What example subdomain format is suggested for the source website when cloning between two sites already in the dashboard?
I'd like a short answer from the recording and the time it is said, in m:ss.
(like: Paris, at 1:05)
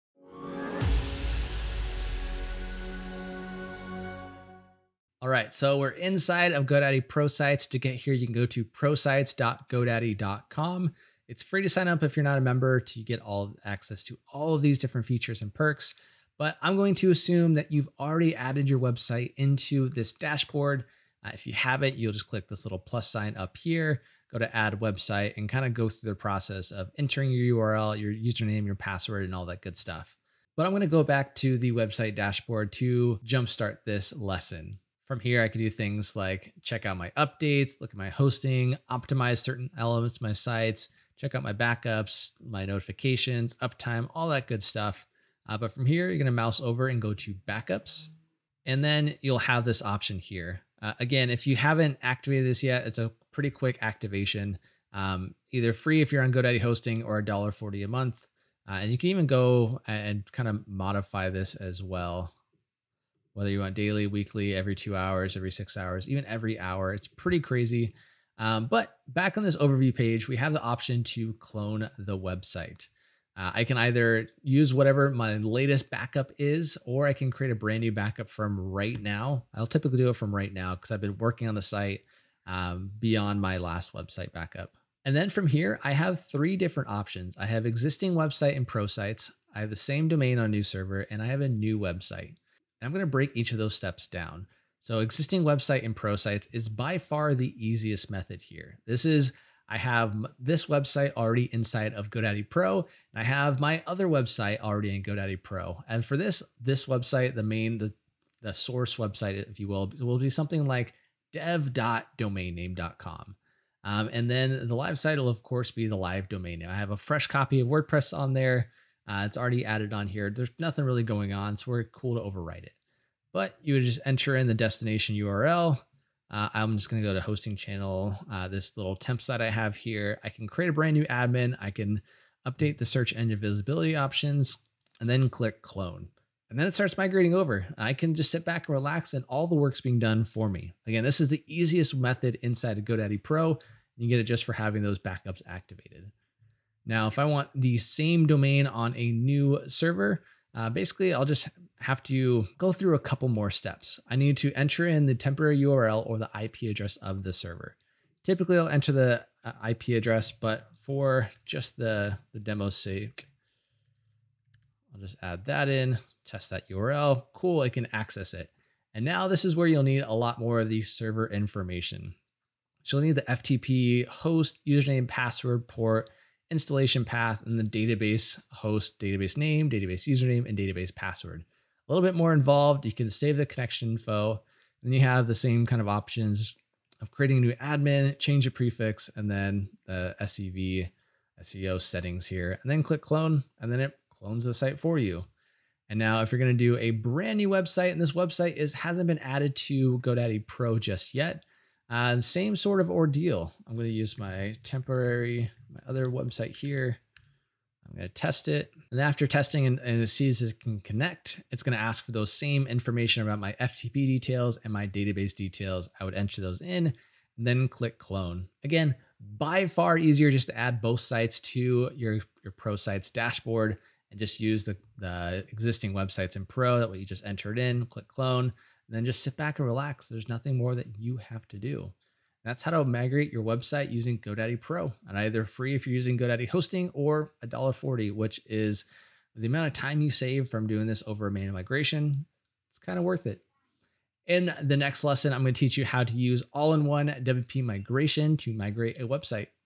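dev.domainname.com, at 1:51.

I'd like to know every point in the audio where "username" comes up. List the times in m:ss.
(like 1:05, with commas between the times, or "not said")
0:28, 2:54, 3:00.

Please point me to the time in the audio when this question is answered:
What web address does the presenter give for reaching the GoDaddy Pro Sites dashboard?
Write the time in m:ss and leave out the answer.
0:08.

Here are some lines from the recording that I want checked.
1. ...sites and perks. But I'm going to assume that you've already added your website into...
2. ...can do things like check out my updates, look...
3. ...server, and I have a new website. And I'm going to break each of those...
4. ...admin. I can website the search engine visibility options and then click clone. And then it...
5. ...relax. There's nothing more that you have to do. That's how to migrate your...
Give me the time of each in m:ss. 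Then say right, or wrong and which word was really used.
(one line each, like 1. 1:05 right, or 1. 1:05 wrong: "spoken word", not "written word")
1. 0:15 wrong: "features", not "sites"
2. 0:35 right
3. 1:30 right
4. 2:11 wrong: "update", not "website"
5. 3:49 right.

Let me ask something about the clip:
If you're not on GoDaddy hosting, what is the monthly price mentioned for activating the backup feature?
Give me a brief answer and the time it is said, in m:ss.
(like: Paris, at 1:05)
$1.40, at 0:57.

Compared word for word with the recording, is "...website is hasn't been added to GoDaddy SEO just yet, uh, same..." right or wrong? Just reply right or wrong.
wrong.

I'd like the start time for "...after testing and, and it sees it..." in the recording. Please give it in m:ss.
3:29.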